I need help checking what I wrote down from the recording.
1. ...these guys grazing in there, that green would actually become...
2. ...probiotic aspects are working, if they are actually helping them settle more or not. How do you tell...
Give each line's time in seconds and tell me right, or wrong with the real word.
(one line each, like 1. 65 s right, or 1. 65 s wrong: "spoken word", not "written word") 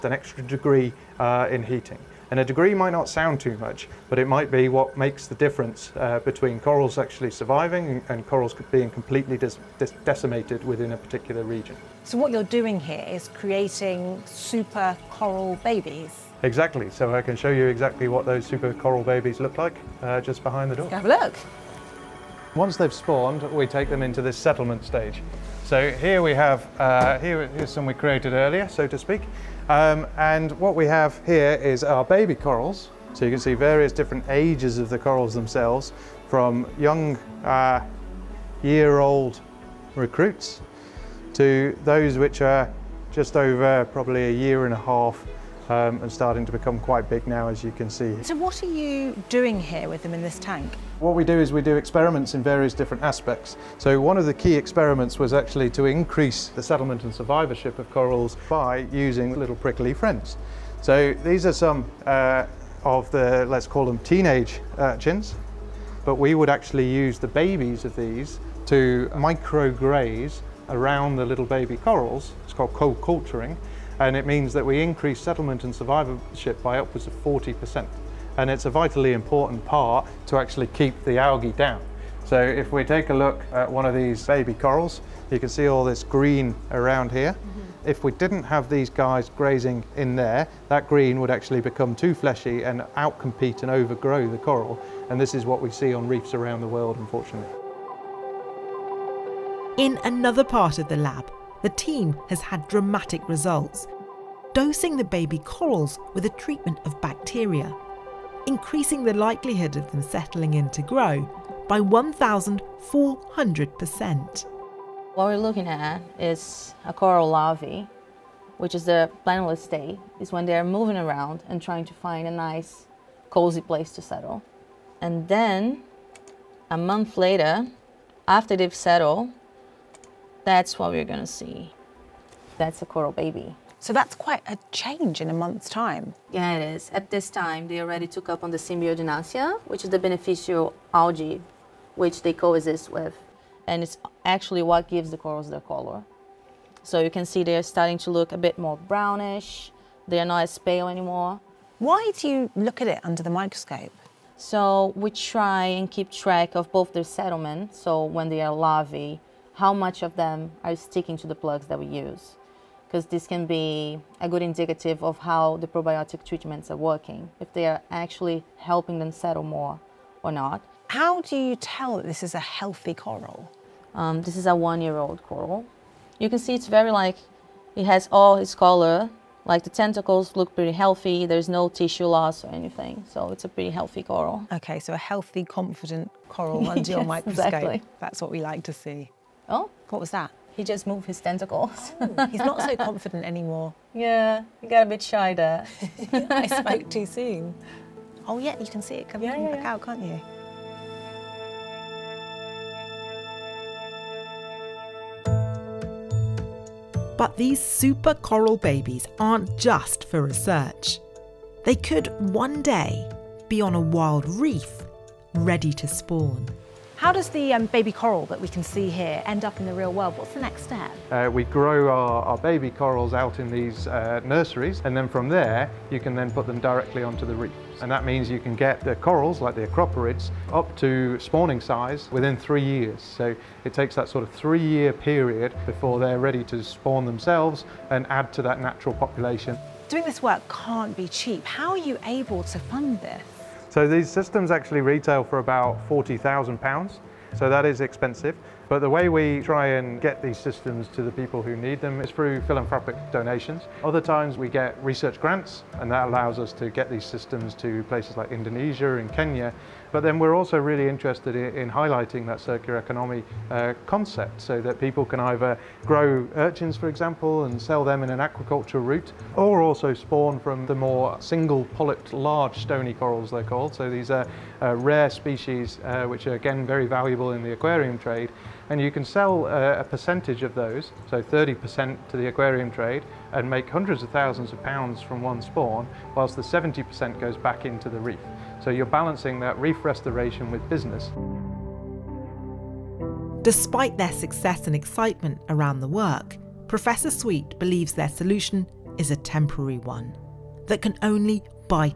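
1. 88 s right
2. 165 s wrong: "treatments", not "aspects".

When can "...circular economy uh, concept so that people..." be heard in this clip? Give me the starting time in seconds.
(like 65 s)
262 s.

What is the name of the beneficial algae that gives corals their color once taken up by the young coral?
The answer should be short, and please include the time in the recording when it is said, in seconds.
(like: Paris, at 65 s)
Symbiodiniaceae, at 138 s.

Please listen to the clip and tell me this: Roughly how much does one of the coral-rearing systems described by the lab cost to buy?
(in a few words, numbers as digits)
£40,000.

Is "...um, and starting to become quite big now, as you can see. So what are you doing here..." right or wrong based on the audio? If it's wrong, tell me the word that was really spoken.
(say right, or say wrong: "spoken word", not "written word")
right.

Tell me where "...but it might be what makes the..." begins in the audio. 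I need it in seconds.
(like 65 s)
4 s.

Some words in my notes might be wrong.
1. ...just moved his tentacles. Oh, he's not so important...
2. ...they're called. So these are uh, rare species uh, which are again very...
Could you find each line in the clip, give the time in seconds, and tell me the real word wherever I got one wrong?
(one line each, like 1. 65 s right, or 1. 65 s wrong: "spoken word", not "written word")
1. 190 s wrong: "confident", not "important"
2. 273 s right.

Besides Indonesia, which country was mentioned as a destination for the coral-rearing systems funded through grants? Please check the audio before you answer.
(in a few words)
Kenya.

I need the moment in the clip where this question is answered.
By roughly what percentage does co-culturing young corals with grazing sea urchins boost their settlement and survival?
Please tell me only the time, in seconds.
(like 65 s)
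77 s.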